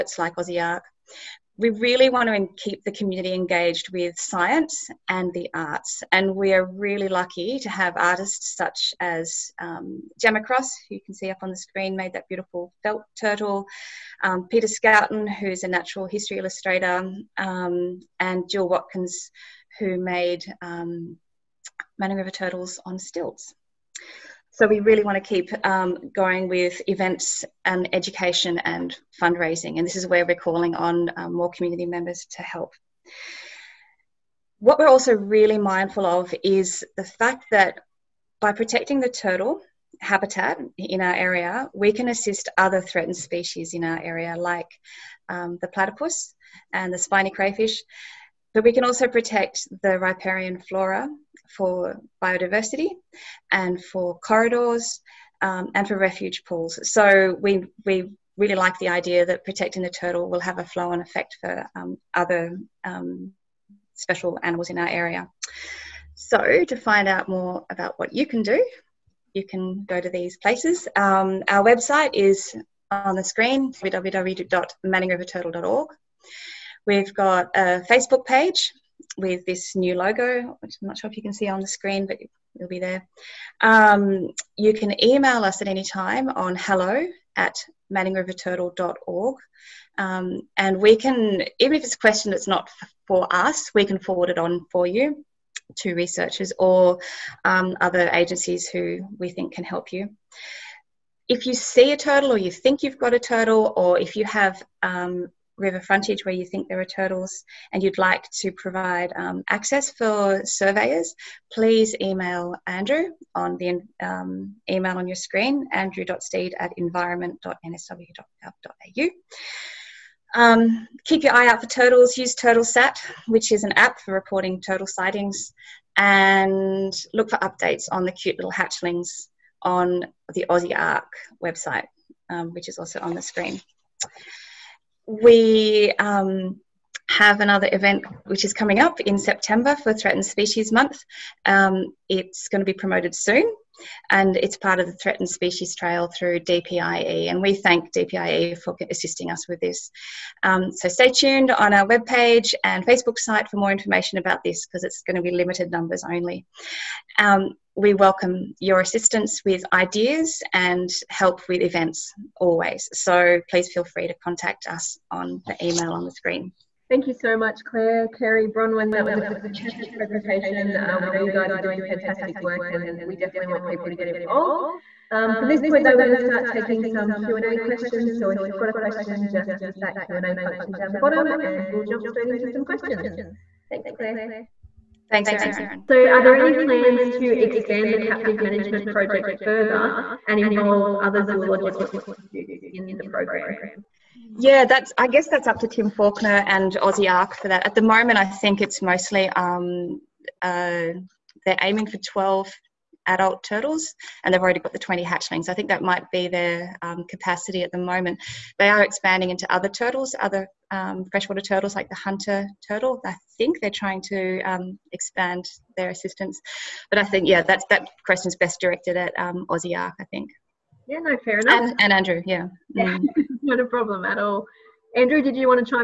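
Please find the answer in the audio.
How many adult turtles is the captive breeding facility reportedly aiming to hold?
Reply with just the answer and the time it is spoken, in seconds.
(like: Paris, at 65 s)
12, at 201 s.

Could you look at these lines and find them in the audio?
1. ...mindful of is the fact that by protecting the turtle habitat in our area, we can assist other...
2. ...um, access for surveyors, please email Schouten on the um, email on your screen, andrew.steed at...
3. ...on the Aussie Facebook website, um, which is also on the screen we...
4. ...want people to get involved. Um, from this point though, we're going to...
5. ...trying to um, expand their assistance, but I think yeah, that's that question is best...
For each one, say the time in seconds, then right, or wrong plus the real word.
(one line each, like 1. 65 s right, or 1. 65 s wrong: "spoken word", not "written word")
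1. 35 s right
2. 109 s wrong: "Andrew", not "Schouten"
3. 129 s wrong: "Ark", not "Facebook"
4. 173 s right
5. 213 s right.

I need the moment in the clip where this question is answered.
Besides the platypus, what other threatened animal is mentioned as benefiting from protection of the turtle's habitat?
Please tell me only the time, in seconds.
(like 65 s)
46 s.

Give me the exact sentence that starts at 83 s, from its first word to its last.
Um, you can email us at any time on hello at manningriverturtle.org.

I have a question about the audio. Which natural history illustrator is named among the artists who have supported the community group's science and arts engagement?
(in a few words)
Peter Schouten.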